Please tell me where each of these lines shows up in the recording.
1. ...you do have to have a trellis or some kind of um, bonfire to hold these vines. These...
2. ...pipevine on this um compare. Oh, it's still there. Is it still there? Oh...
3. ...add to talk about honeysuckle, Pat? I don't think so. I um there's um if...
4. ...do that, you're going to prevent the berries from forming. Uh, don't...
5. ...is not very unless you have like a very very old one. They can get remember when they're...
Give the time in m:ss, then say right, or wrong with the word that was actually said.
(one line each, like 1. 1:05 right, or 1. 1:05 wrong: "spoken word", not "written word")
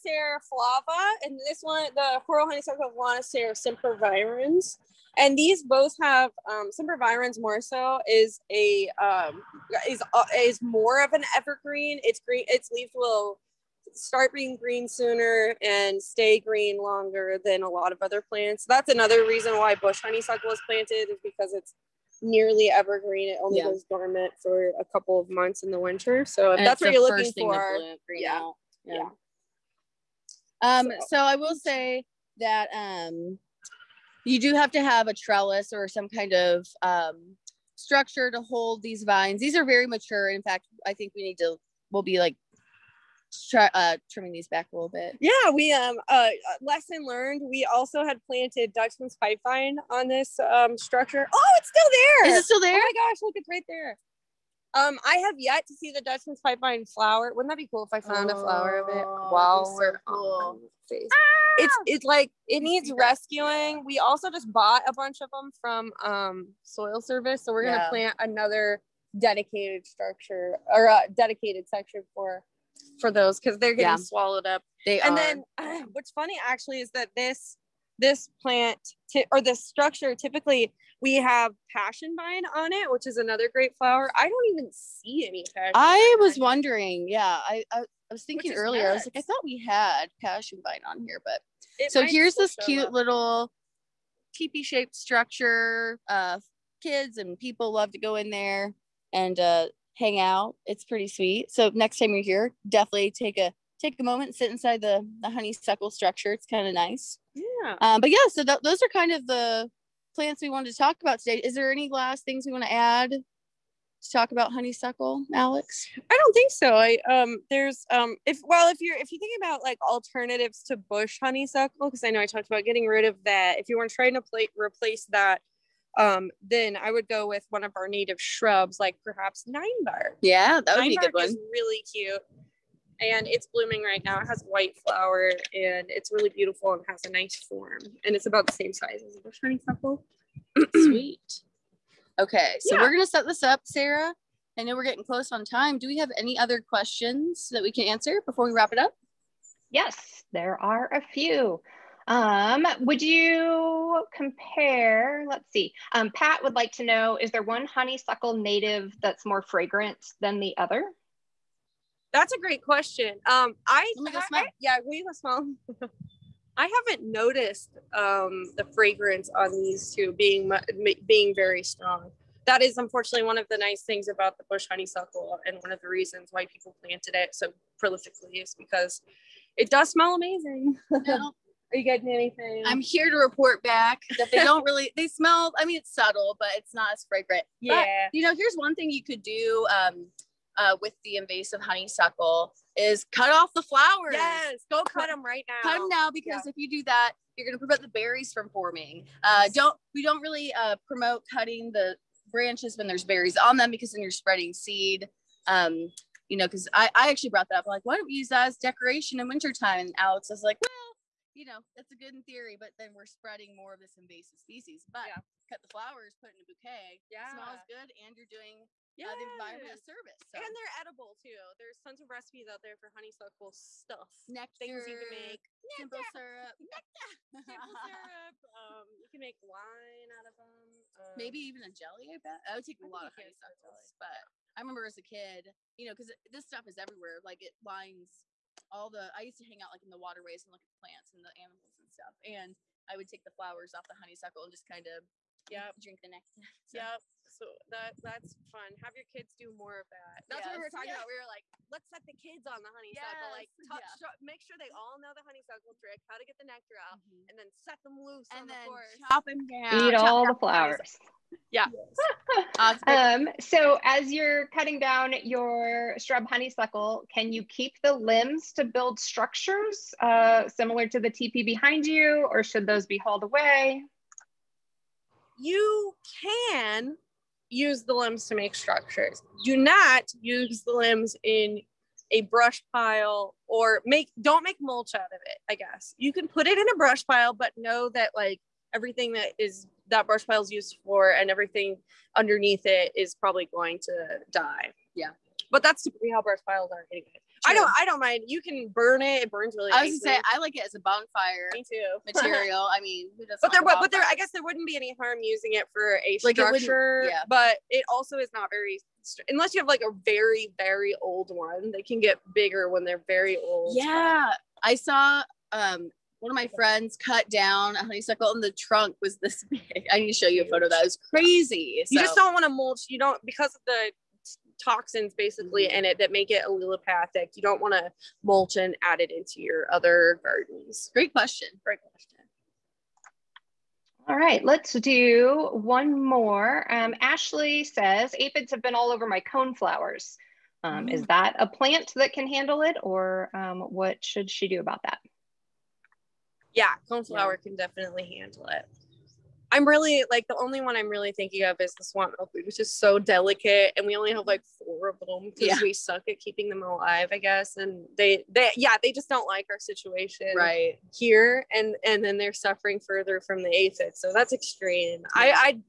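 1. 0:34 wrong: "structure", not "bonfire"
2. 0:49 wrong: "structure", not "compare"
3. 1:52 wrong: "Alix", not "Pat"
4. 3:16 right
5. 5:08 wrong: "bigger", not "remember".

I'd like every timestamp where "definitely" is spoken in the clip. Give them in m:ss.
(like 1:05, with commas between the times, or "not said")
1:42, 5:47.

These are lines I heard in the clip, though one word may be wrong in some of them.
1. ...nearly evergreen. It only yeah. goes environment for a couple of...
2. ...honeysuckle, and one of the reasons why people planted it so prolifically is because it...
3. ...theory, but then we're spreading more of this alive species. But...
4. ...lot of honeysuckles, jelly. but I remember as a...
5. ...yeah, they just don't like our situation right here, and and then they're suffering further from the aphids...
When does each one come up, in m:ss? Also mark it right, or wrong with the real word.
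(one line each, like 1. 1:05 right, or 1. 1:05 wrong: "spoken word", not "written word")
1. 0:22 wrong: "dormant", not "environment"
2. 2:54 right
3. 3:32 wrong: "invasive", not "alive"
4. 3:52 right
5. 5:58 right.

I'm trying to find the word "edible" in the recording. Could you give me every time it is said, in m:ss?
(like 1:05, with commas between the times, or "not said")
3:40.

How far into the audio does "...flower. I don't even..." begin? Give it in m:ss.
1:23.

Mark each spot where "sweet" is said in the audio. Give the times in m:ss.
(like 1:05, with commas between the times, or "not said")
1:41, 2:20.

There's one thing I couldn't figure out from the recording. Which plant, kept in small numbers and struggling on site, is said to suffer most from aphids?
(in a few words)
swamp milkweed.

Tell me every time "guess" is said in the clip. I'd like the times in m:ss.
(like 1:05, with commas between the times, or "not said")
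4:45, 5:04, 5:57.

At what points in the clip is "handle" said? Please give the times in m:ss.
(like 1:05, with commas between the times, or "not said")
5:42, 5:48.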